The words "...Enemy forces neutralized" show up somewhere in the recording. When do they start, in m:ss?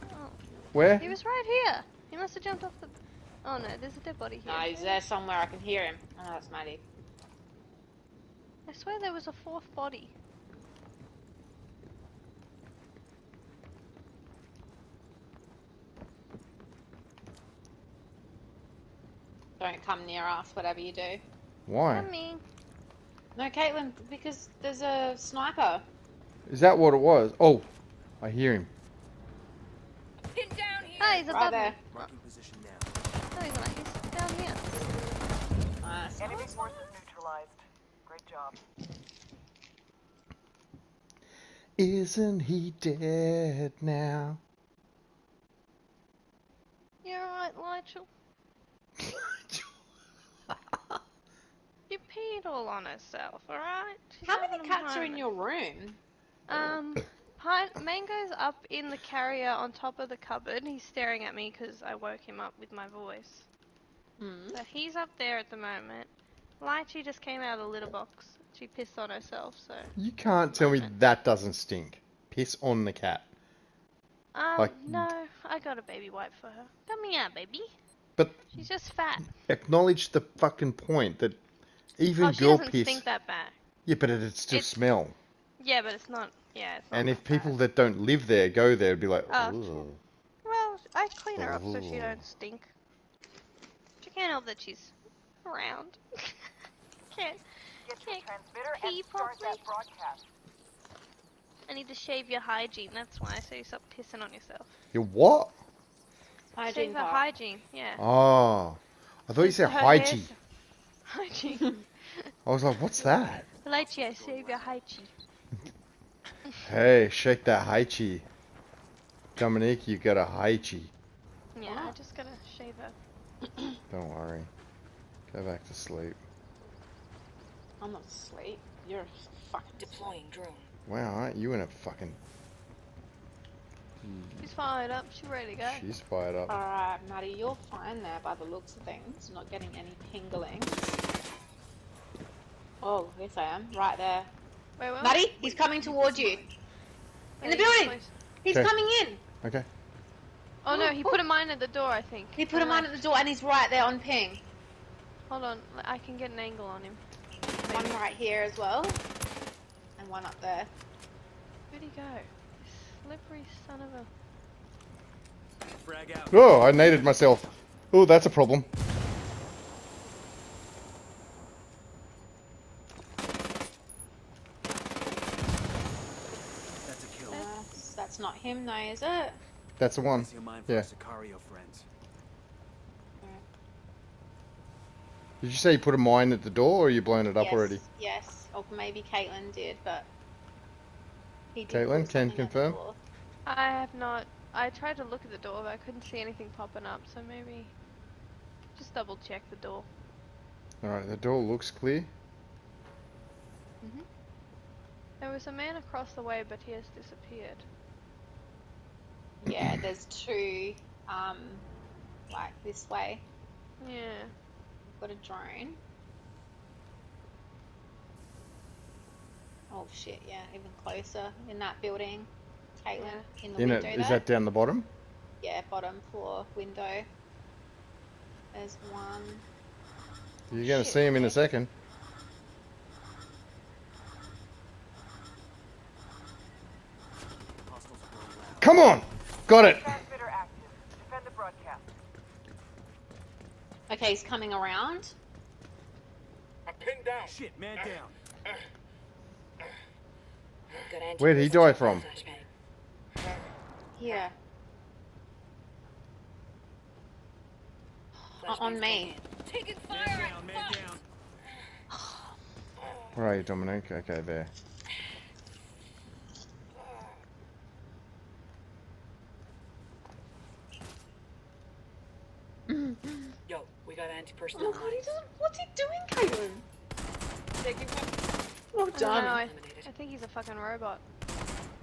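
0:36.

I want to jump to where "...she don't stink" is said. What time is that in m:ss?
1:31.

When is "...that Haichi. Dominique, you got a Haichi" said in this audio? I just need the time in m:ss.
1:57.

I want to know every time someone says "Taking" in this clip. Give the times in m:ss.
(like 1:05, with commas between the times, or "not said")
4:19, 4:37.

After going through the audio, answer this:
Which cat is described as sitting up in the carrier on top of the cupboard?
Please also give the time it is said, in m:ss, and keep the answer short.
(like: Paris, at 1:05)
Pine Mango, at 0:57.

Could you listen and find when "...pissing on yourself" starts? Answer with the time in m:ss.
1:43.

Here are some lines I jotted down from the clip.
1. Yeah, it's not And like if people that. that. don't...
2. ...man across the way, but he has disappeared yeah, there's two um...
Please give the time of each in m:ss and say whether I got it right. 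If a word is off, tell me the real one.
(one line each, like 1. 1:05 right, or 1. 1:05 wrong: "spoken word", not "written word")
1. 1:26 right
2. 3:25 right.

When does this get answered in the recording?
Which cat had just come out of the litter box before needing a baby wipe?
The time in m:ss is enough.
1:06.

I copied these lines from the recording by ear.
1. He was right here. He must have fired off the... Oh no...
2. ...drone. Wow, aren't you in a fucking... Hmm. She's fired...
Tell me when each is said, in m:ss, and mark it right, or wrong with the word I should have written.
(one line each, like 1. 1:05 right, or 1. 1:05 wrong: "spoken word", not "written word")
1. 0:00 wrong: "jumped", not "fired"
2. 2:10 right.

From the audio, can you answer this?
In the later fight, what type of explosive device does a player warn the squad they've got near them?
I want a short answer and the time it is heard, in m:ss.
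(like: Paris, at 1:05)
Anti-personnel, at 4:34.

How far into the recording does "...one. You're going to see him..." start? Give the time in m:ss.
3:48.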